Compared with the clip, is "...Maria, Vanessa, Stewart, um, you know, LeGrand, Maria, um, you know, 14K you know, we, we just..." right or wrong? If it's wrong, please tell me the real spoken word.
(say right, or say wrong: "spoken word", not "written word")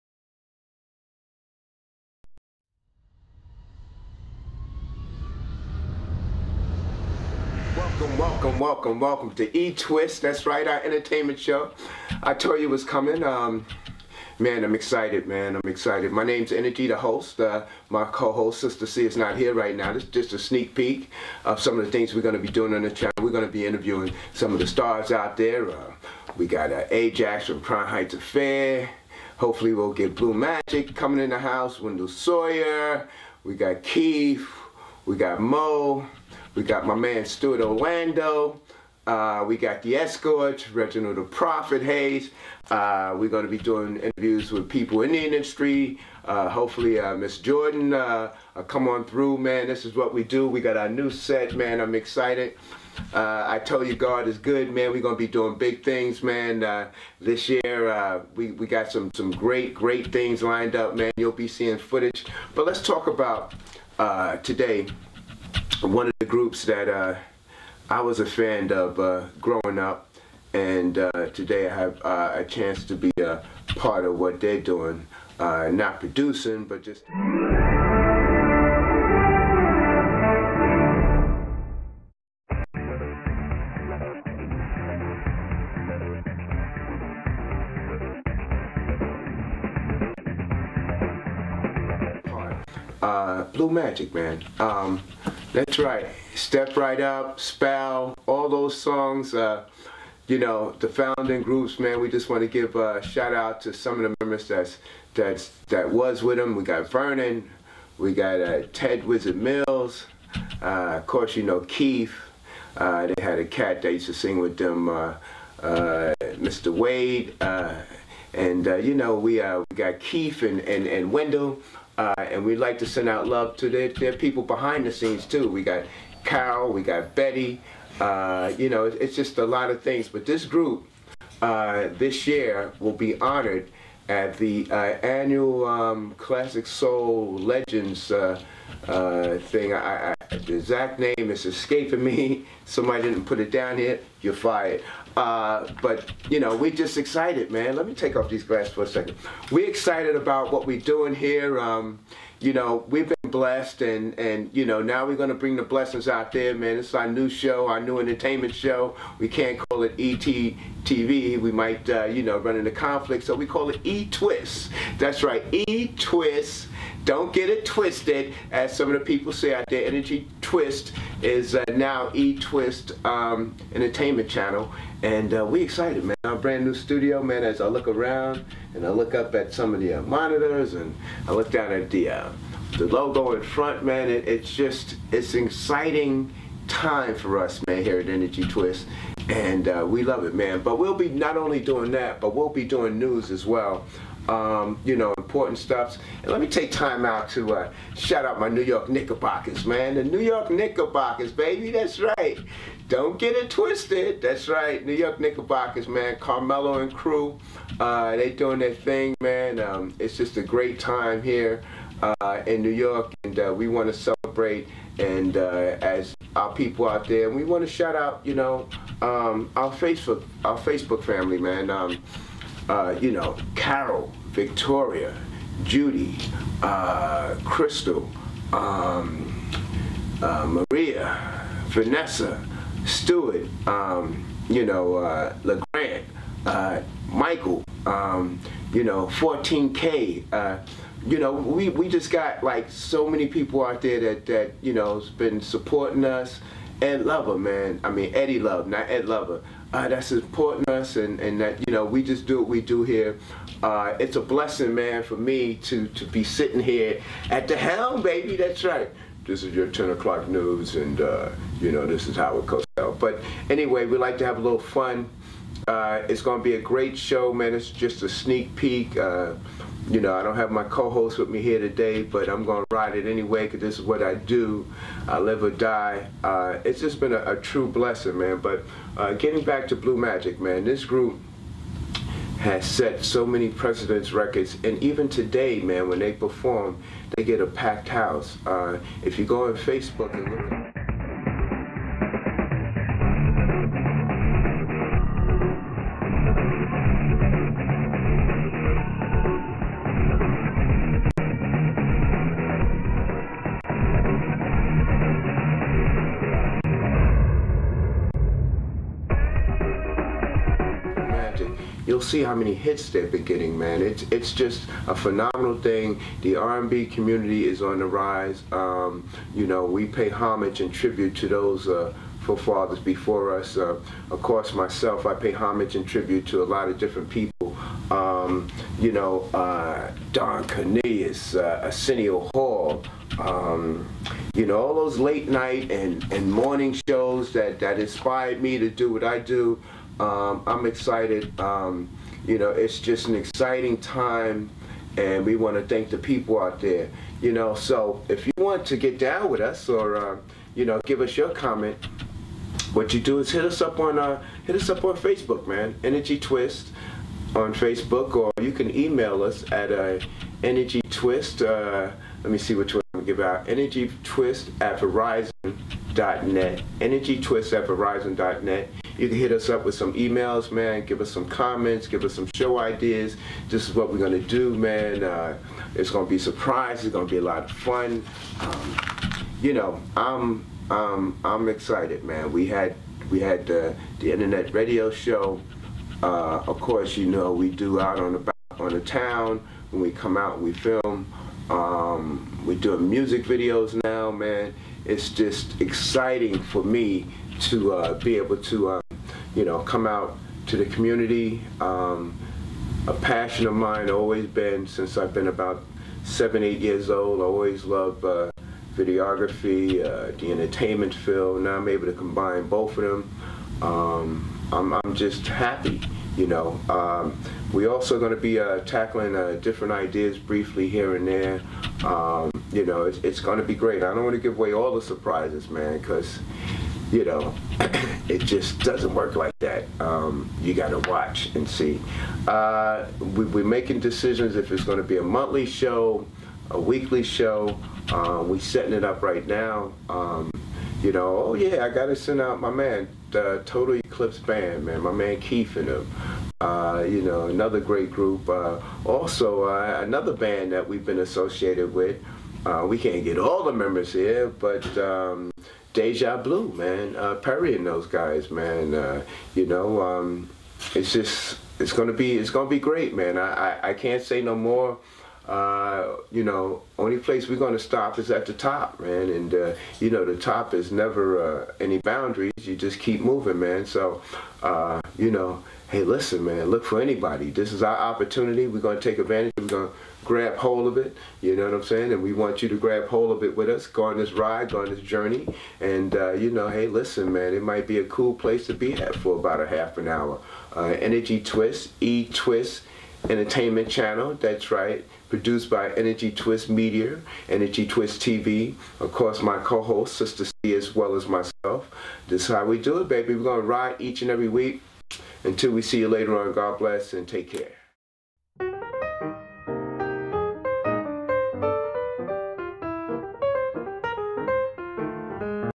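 wrong: "Michael", not "Maria".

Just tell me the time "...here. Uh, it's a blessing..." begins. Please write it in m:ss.
4:12.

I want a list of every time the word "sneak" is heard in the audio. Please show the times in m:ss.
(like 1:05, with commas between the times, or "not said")
0:20, 4:28.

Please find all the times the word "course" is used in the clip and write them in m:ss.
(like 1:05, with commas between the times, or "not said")
1:51, 5:24, 6:26, 8:18.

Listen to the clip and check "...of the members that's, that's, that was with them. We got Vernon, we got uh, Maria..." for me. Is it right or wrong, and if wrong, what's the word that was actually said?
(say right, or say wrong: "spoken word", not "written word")
wrong: "Ted", not "Maria".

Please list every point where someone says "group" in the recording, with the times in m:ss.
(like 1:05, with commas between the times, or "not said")
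1:06, 1:41, 2:10, 4:40, 7:27.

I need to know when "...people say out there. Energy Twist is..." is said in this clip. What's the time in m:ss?
2:49.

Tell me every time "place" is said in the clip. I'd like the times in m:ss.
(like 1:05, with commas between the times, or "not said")
7:46, 8:08.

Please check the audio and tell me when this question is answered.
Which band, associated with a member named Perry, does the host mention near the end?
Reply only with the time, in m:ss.
7:35.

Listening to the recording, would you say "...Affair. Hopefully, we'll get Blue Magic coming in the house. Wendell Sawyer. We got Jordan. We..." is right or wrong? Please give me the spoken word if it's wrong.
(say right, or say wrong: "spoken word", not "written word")
wrong: "Keith", not "Jordan".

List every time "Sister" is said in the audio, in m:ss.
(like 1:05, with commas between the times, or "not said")
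0:18, 8:19.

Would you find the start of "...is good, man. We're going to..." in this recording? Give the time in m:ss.
0:54.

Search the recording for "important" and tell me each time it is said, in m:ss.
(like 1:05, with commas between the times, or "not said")
3:15.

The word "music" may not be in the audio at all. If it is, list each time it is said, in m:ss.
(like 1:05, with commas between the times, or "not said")
6:32.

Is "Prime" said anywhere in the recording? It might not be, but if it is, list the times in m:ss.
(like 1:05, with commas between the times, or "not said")
0:27.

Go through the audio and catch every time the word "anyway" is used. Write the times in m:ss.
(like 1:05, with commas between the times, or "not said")
4:23, 4:33.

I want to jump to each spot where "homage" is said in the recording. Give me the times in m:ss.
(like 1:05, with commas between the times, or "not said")
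5:20, 5:25.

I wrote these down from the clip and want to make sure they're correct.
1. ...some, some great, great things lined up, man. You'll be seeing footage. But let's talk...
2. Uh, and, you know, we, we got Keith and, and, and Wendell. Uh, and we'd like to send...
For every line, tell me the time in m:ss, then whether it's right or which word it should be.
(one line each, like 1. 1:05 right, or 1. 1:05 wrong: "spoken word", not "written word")
1. 0:58 right
2. 1:57 right.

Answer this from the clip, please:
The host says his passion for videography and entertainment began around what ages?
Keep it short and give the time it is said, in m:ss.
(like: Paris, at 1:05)
7, 8, at 6:46.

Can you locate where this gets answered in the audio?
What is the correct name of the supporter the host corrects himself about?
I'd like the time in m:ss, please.
4:08.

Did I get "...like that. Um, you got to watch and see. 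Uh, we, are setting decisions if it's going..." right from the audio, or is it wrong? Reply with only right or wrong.
wrong.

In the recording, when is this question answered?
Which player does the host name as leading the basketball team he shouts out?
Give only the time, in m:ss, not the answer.
3:26.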